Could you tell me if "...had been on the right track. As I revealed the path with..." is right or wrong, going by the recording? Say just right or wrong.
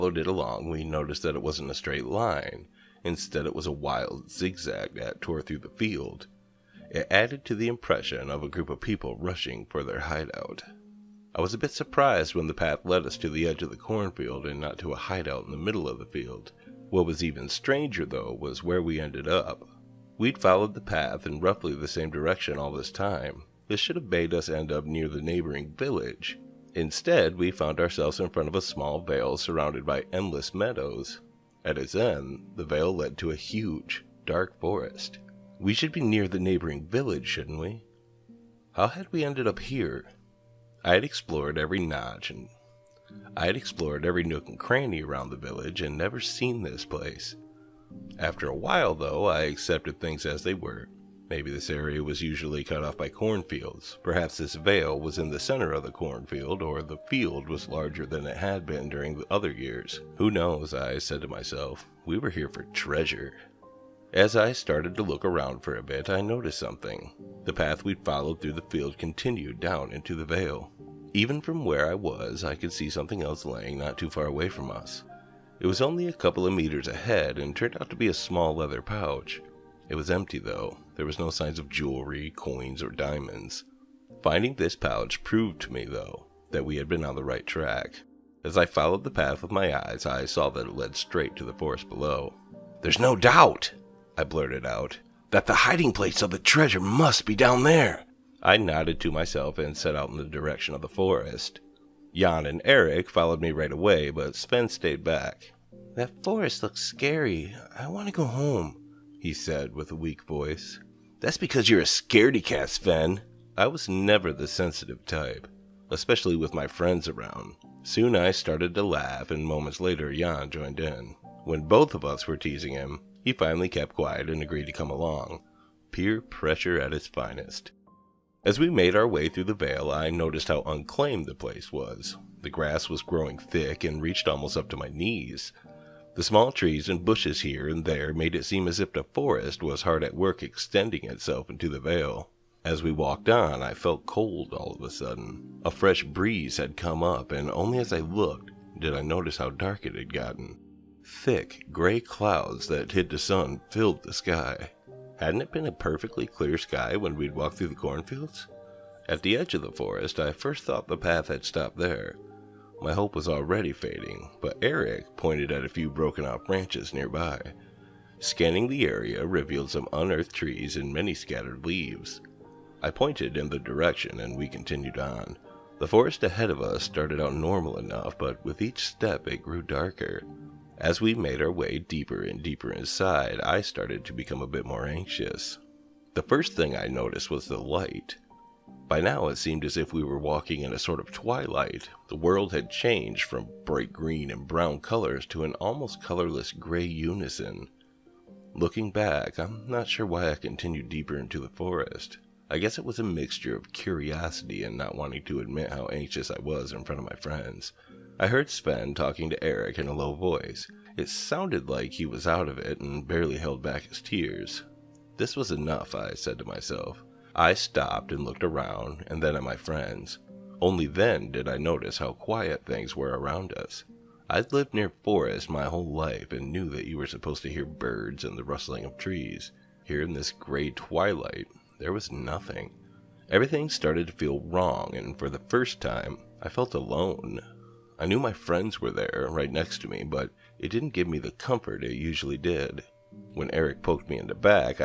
wrong.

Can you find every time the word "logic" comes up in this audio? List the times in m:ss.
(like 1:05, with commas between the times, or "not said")
not said.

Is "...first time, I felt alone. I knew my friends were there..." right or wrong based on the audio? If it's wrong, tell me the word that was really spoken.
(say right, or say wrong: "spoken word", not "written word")
right.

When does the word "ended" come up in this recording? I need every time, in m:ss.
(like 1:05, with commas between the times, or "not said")
0:18, 0:39.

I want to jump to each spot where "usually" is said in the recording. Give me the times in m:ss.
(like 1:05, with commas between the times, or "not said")
0:52, 4:01.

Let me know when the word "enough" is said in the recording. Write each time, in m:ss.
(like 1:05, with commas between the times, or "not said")
2:57, 3:35.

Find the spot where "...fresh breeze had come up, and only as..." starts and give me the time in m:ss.
2:25.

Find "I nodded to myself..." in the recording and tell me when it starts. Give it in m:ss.
1:38.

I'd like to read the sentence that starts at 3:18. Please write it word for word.
Looking back, I'm not sure why I continued deeper into the forest.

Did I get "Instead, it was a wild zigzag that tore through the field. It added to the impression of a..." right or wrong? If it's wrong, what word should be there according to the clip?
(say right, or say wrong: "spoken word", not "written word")
right.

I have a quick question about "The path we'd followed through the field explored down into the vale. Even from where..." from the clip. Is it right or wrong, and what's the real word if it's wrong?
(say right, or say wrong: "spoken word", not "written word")
wrong: "continued", not "explored".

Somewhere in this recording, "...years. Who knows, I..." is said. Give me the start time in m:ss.
0:59.